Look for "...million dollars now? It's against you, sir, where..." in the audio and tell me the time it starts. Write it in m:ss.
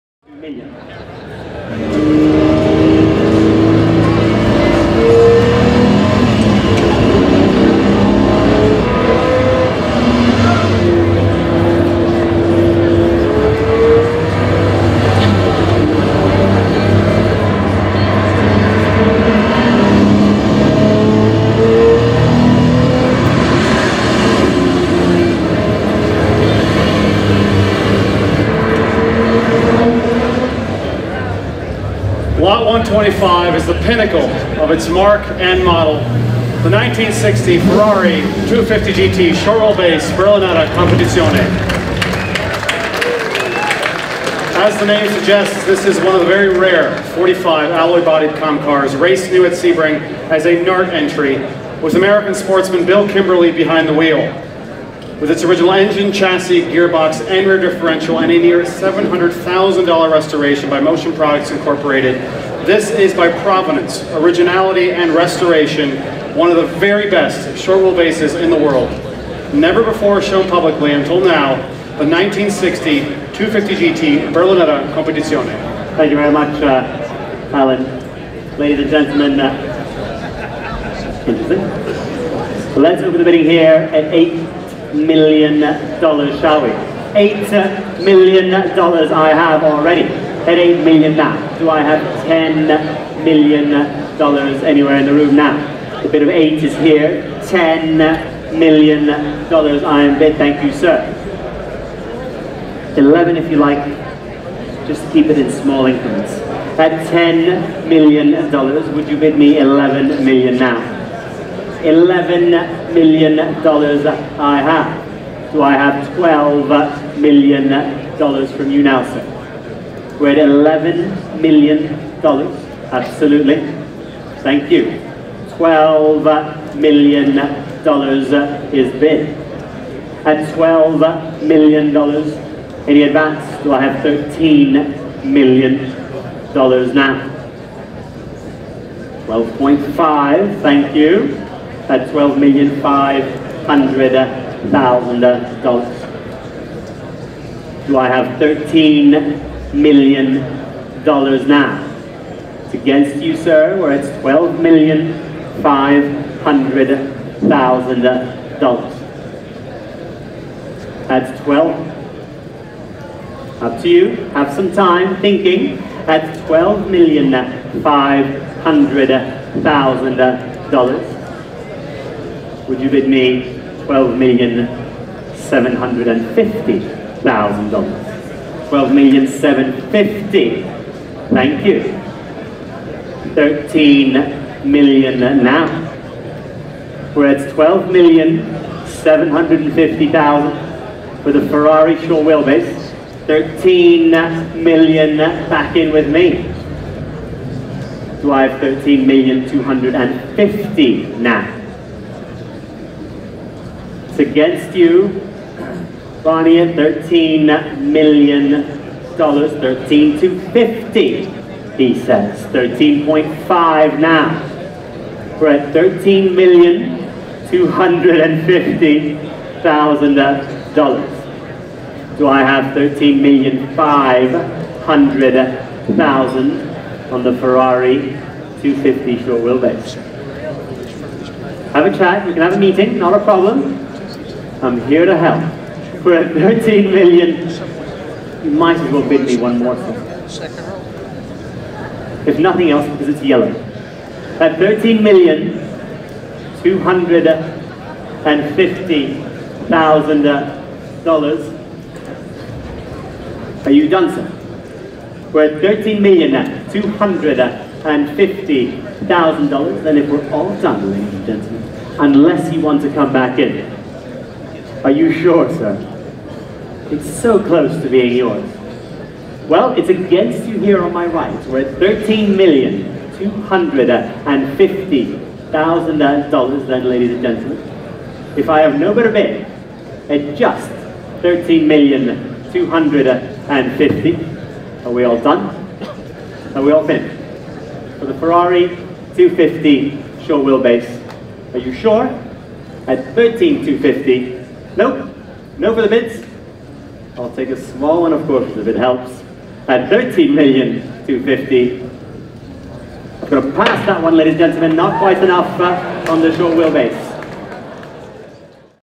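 2:29.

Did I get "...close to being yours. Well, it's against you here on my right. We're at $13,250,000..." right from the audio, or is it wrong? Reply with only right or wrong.
right.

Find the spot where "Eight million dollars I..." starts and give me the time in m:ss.
1:27.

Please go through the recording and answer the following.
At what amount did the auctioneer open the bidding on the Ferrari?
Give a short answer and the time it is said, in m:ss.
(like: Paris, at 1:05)
$8 million, at 1:24.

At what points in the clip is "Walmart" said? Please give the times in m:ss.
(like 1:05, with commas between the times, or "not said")
not said.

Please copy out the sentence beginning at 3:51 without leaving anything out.
Have a chat, we can have a meeting, not a problem.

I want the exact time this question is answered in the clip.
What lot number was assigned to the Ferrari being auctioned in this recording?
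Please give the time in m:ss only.
0:32.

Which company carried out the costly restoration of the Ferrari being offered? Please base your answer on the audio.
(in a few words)
Motion Products Incorporated.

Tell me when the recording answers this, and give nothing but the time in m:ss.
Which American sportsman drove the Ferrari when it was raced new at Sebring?
0:52.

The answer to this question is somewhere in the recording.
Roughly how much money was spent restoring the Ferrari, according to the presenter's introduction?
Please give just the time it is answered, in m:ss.
0:58.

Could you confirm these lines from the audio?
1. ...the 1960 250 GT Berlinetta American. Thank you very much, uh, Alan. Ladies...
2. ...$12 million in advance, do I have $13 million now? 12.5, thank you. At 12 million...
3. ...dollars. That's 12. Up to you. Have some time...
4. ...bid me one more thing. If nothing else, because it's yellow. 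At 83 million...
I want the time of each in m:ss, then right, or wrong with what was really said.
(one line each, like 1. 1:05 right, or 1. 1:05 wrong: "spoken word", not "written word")
1. 1:11 wrong: "Competizione", not "American"
2. 2:10 right
3. 2:38 right
4. 3:59 wrong: "13", not "83".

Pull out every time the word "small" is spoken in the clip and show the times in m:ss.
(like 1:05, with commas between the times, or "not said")
1:45, 4:57.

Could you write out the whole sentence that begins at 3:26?
Barney at 13 million dollars, 13 to 50, he says.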